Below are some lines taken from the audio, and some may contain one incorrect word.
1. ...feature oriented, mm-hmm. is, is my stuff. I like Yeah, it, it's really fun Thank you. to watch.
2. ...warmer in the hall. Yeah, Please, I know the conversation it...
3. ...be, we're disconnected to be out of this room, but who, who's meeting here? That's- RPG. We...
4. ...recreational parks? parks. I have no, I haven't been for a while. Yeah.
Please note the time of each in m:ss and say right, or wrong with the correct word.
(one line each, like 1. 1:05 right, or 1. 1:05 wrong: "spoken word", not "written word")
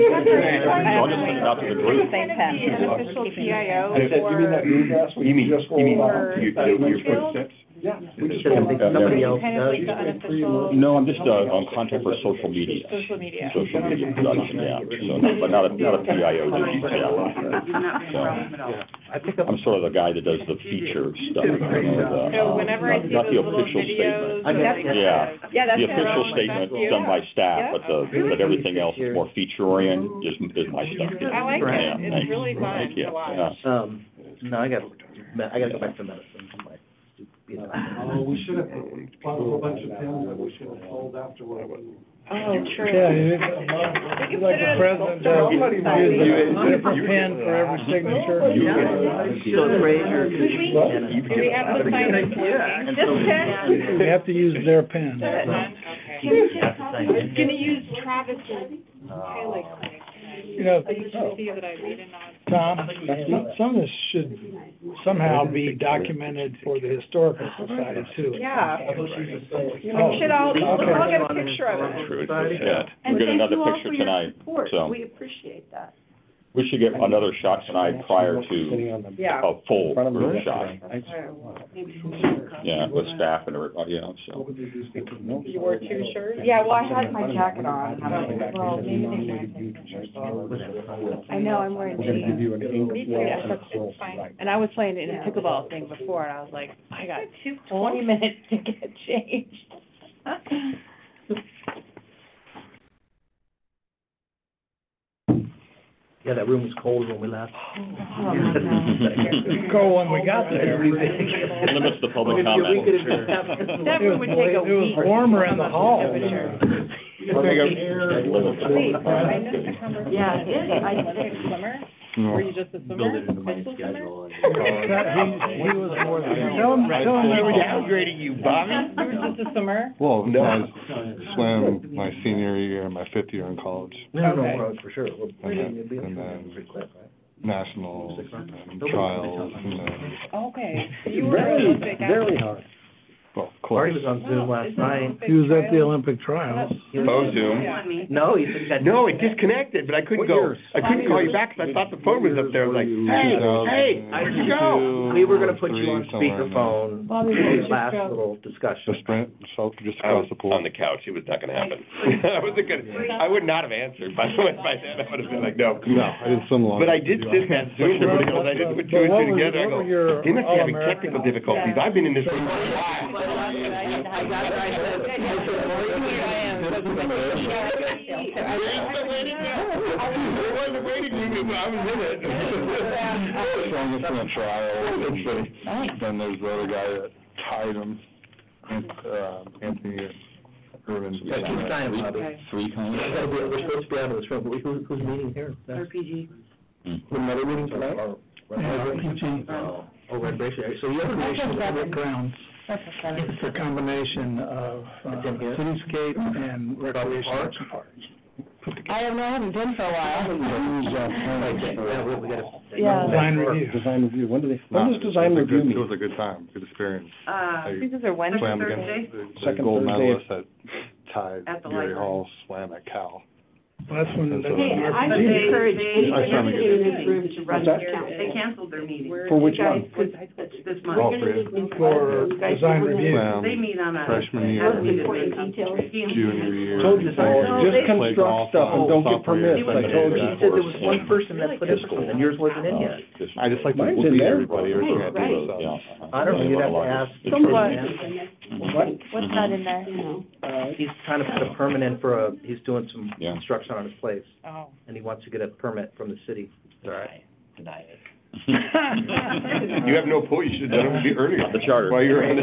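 1. 0:29 right
2. 1:55 right
3. 3:13 wrong: "supposed", not "disconnected"
4. 3:26 right.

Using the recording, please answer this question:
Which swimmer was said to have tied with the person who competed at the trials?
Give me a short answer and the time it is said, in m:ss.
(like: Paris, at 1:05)
Anthony Ervin, at 3:09.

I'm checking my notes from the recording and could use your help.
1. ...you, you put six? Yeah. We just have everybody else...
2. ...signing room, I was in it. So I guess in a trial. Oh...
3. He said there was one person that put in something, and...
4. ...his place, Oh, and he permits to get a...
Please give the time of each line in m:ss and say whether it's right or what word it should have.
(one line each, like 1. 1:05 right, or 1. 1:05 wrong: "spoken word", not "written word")
1. 0:06 wrong: "somebody", not "everybody"
2. 3:00 wrong: "waiting", not "signing"
3. 4:00 right
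4. 4:13 wrong: "wants", not "permits".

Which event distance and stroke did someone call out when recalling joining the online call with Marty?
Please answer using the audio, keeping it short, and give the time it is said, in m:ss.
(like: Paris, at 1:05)
200 IM, at 2:55.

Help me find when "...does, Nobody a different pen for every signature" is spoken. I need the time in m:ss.
0:45.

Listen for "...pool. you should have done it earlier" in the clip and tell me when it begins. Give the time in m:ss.
4:20.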